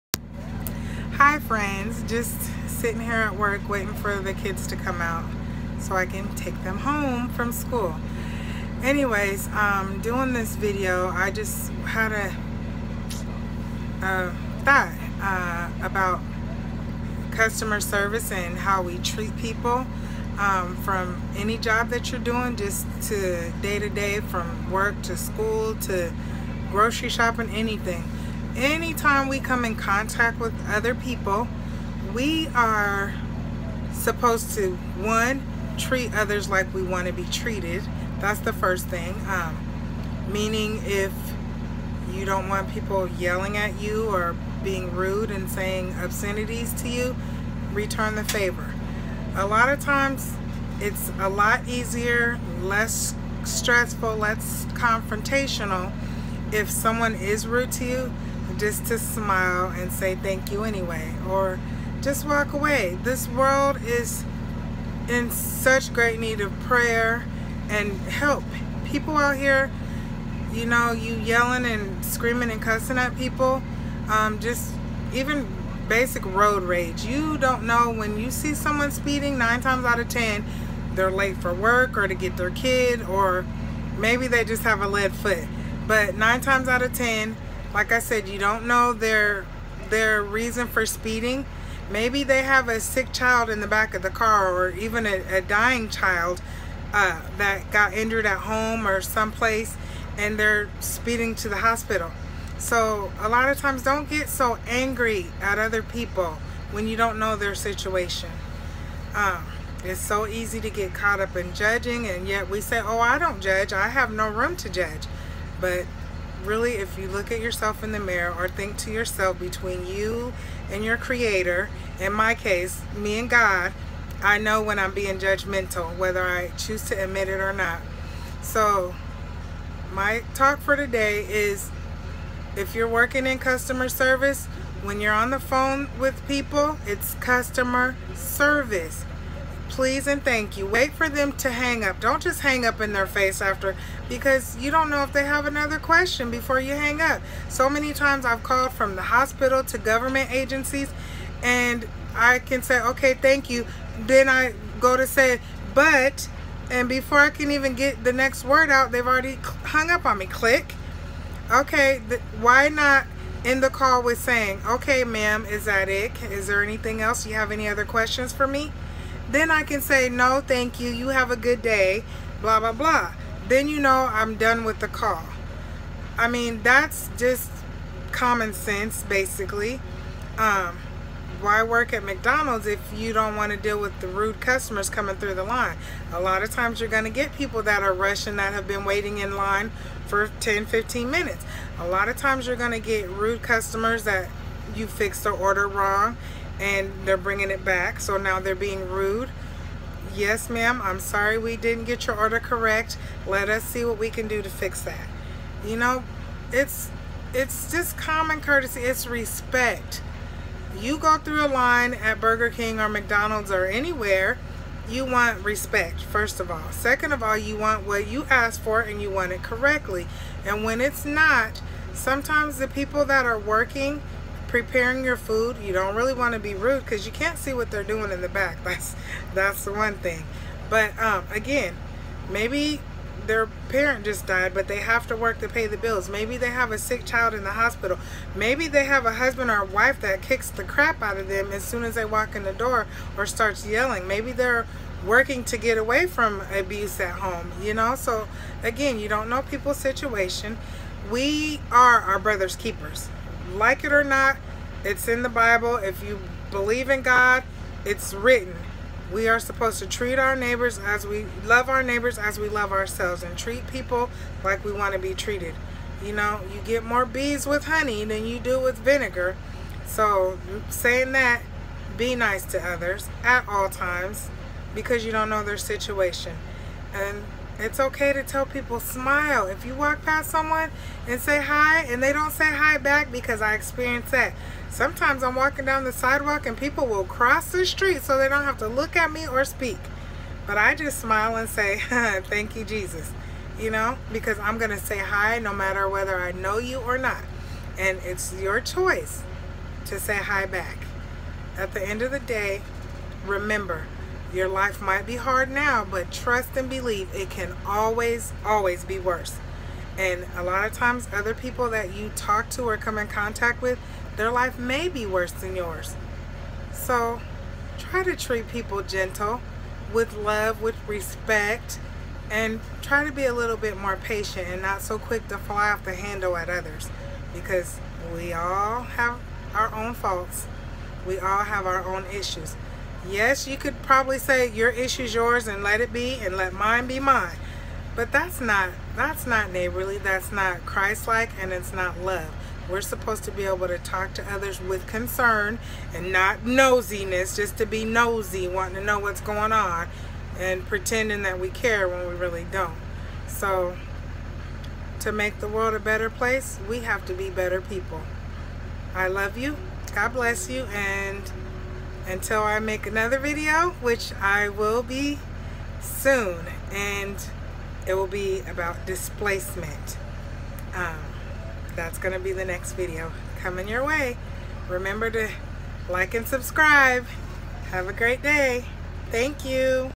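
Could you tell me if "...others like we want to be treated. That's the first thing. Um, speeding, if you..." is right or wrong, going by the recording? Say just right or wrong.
wrong.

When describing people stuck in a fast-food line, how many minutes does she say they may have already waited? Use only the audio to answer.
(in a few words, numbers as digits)
10, 15 minutes.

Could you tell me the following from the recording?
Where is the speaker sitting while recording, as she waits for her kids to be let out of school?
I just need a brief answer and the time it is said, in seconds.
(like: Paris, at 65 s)
At work, at 3 s.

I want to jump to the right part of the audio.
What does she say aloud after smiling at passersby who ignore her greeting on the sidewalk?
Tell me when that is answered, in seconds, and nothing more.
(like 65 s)
292 s.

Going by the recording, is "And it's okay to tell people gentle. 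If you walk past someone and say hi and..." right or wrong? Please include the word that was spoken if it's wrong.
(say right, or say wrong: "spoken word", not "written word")
wrong: "smile", not "gentle".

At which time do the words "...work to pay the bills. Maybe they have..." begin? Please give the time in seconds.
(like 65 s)
235 s.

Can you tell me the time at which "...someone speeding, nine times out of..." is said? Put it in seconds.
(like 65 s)
78 s.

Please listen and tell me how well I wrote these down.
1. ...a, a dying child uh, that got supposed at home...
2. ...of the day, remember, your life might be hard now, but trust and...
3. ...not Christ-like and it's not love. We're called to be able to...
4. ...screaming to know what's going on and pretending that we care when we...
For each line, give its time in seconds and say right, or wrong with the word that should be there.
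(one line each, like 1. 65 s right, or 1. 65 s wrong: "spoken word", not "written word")
1. 95 s wrong: "injured", not "supposed"
2. 302 s right
3. 340 s wrong: "supposed", not "called"
4. 348 s wrong: "wanting", not "screaming".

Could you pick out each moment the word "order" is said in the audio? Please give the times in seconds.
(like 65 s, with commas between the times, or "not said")
195 s, 202 s.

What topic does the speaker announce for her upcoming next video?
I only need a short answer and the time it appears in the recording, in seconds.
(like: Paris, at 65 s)
Displacement, at 368 s.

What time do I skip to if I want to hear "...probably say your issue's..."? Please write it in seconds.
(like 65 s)
333 s.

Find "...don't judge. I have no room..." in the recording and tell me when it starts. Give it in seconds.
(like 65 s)
113 s.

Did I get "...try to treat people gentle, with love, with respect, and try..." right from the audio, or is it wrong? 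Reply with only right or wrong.
right.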